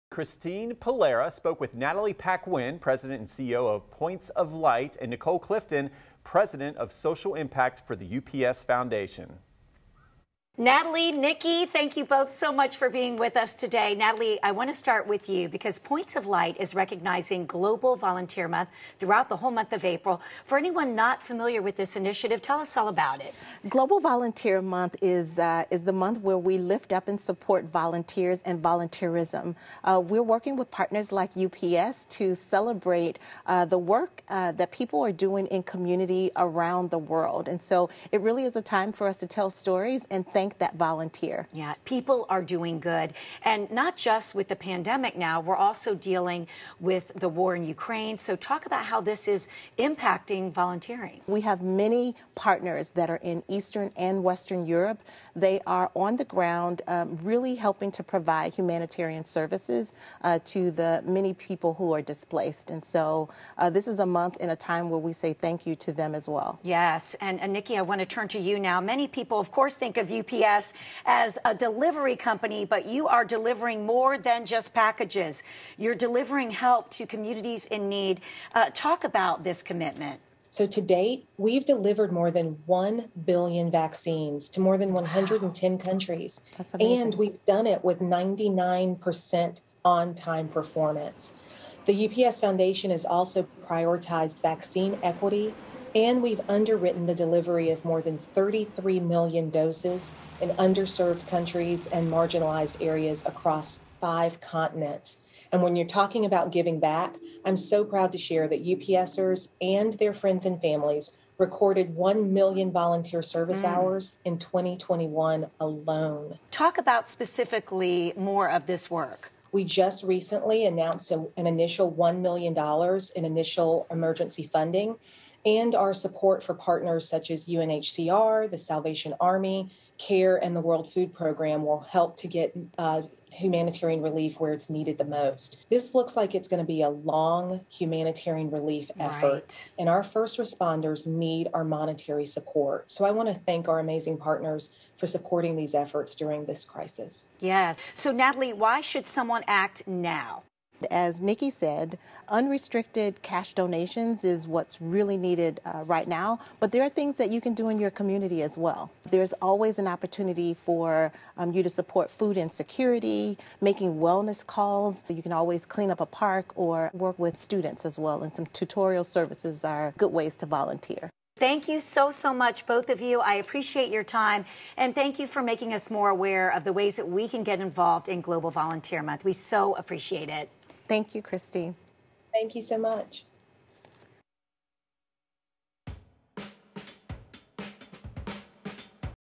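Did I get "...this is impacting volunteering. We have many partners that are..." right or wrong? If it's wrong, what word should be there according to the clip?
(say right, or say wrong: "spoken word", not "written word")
right.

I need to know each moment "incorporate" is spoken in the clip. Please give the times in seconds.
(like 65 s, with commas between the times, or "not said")
not said.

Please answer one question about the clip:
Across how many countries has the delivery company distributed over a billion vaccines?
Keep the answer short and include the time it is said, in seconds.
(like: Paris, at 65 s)
110, at 84 s.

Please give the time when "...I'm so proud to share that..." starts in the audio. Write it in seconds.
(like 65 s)
107 s.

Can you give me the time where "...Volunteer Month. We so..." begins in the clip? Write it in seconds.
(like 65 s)
178 s.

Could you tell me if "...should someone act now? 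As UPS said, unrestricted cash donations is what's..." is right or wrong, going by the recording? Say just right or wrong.
wrong.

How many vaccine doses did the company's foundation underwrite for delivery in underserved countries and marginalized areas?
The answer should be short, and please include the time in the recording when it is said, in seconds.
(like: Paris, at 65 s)
33 million, at 98 s.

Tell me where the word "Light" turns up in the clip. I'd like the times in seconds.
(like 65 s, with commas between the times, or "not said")
4 s, 16 s.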